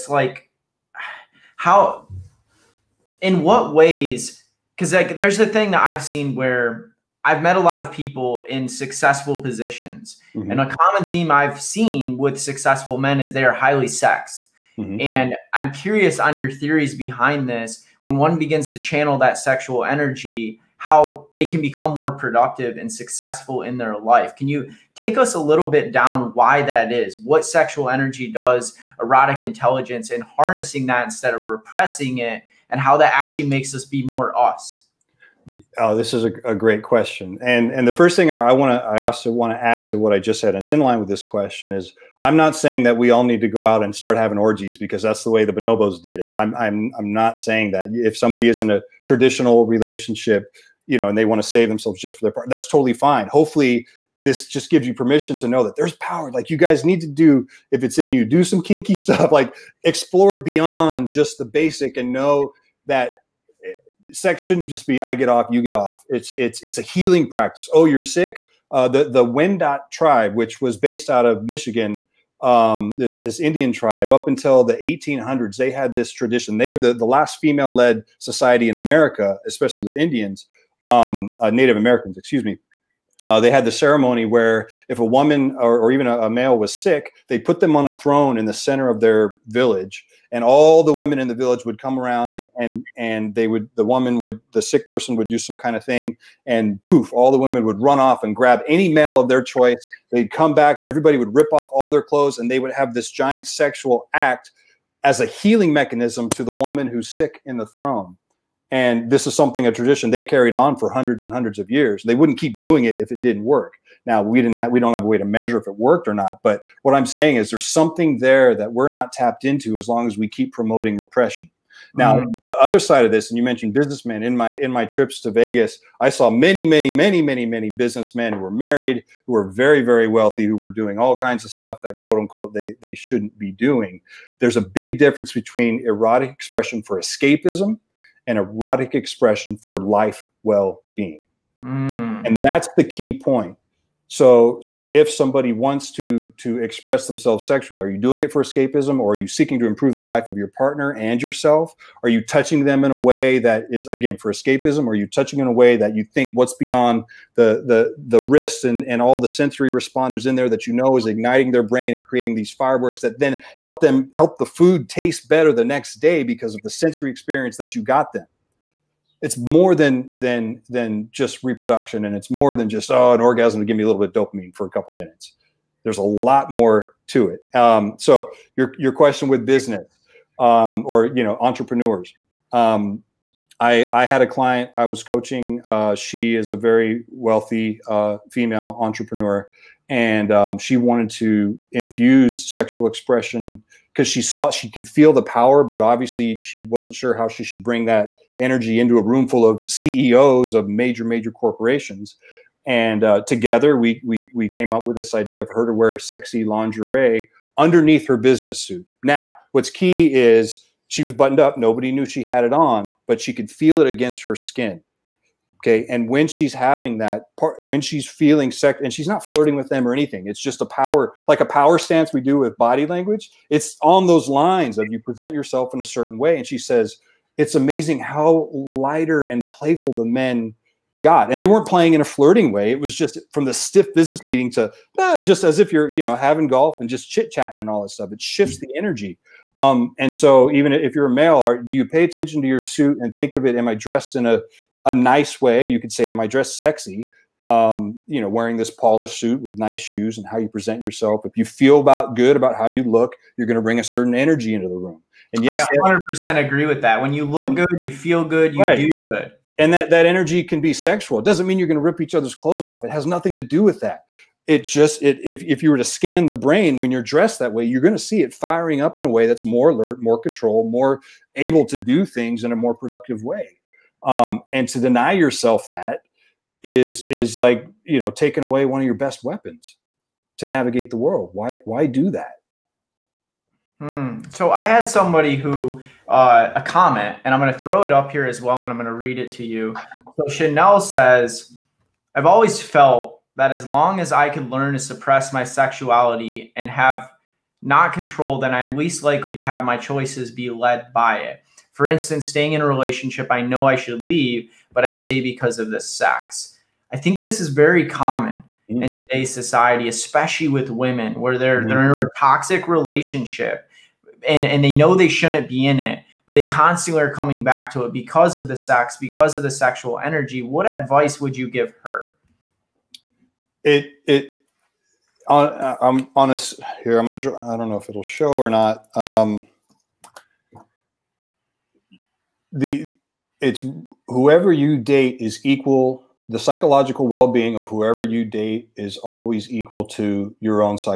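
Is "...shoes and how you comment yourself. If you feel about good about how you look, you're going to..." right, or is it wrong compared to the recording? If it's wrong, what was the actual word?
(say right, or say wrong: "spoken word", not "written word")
wrong: "present", not "comment".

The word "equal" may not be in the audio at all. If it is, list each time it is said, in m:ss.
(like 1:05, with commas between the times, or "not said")
5:35, 5:39.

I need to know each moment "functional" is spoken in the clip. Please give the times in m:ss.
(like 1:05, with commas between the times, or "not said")
not said.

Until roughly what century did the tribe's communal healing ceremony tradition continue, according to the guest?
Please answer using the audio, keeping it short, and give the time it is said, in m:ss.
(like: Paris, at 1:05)
1800s, at 1:14.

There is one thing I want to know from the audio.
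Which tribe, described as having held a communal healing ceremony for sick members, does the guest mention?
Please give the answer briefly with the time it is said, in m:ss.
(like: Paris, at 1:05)
Wendat, at 1:09.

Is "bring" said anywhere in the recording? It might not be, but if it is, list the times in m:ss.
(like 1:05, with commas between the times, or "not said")
3:17, 4:13.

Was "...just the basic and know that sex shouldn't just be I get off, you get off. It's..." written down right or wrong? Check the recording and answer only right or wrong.
right.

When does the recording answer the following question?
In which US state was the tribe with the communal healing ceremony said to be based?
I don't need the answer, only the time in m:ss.
1:11.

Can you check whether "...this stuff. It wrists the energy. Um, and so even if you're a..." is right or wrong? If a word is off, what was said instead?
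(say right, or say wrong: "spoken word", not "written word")
wrong: "shifts", not "wrists".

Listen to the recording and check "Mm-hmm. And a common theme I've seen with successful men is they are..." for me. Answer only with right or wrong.
right.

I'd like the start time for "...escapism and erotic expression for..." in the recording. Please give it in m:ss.
2:16.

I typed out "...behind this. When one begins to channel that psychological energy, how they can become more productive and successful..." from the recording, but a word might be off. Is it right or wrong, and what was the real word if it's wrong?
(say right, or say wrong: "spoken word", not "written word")
wrong: "sexual", not "psychological".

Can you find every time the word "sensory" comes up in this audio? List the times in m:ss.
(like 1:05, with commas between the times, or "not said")
2:39, 2:46.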